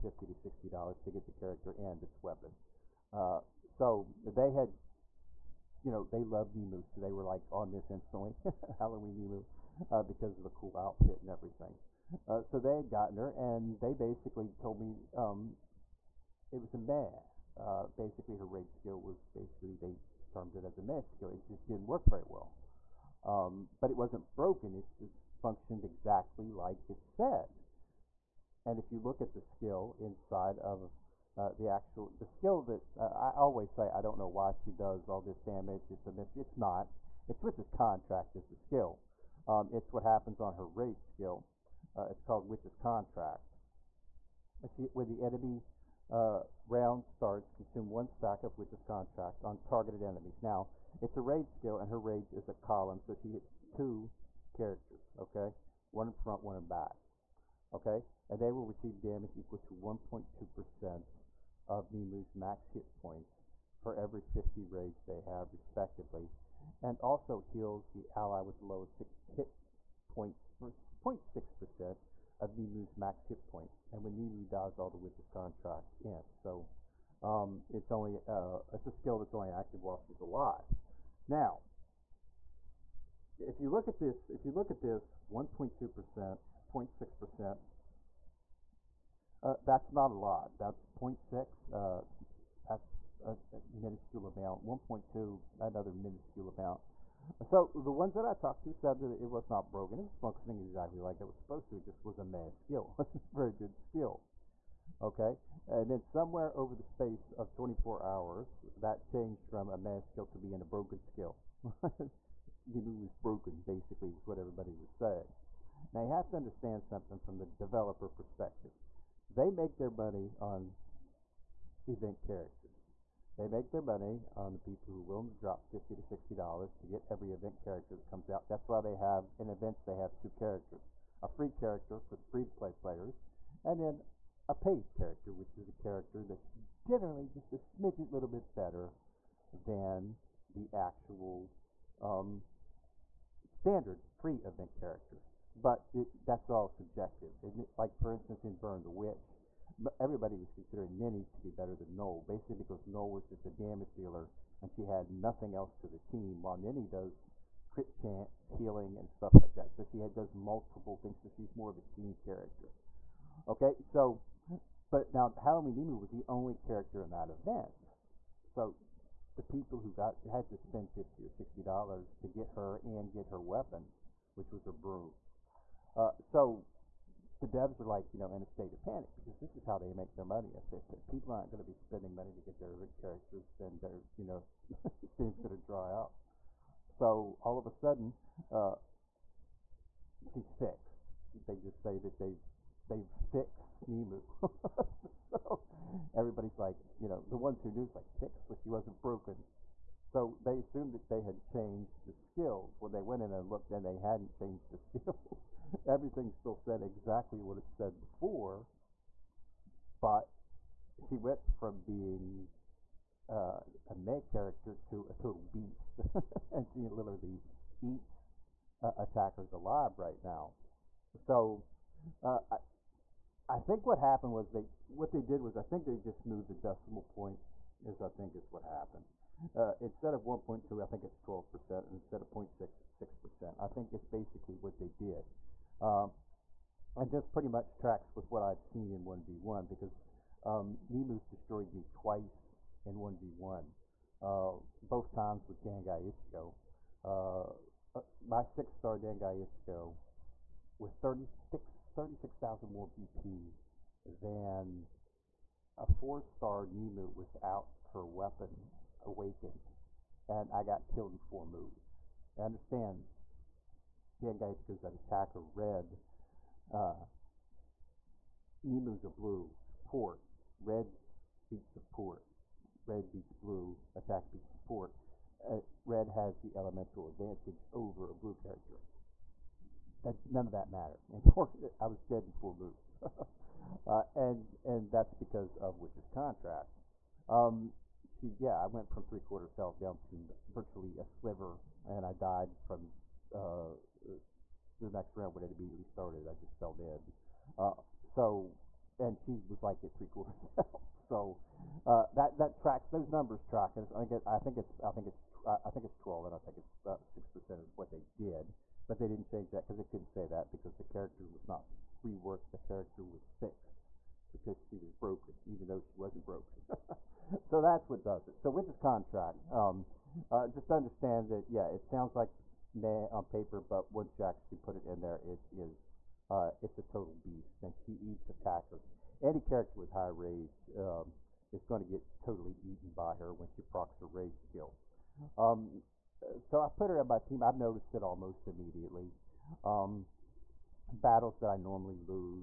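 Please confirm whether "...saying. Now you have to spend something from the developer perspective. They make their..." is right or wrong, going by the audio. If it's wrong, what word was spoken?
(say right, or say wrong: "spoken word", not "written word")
wrong: "understand", not "spend".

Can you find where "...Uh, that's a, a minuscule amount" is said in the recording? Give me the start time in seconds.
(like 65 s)
91 s.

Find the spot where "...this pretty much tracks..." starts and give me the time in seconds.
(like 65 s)
237 s.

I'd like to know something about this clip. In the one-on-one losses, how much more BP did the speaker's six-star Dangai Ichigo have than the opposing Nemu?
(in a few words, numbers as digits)
36,000.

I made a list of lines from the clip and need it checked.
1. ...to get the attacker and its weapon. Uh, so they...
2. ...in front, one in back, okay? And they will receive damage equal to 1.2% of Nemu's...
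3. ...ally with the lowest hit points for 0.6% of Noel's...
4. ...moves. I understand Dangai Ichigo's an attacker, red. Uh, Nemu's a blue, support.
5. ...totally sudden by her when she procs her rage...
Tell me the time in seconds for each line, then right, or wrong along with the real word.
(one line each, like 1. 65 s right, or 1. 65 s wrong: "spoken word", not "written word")
1. 1 s wrong: "character", not "attacker"
2. 56 s right
3. 68 s wrong: "Nemu", not "Noel"
4. 261 s right
5. 332 s wrong: "eaten", not "sudden".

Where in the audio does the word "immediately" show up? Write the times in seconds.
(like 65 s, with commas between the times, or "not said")
295 s, 338 s.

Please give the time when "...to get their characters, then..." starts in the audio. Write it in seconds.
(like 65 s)
182 s.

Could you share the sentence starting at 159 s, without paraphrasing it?
So she had, does multiple things, so she's more of a team character.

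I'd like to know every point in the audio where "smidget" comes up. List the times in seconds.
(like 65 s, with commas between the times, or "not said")
137 s.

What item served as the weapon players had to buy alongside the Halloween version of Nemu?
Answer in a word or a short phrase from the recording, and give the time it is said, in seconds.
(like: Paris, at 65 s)
Her broom, at 174 s.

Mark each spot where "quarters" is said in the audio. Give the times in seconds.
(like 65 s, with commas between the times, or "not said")
289 s, 300 s.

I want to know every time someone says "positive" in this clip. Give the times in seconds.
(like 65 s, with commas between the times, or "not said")
not said.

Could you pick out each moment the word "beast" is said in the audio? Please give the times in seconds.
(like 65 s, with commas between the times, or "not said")
215 s, 327 s.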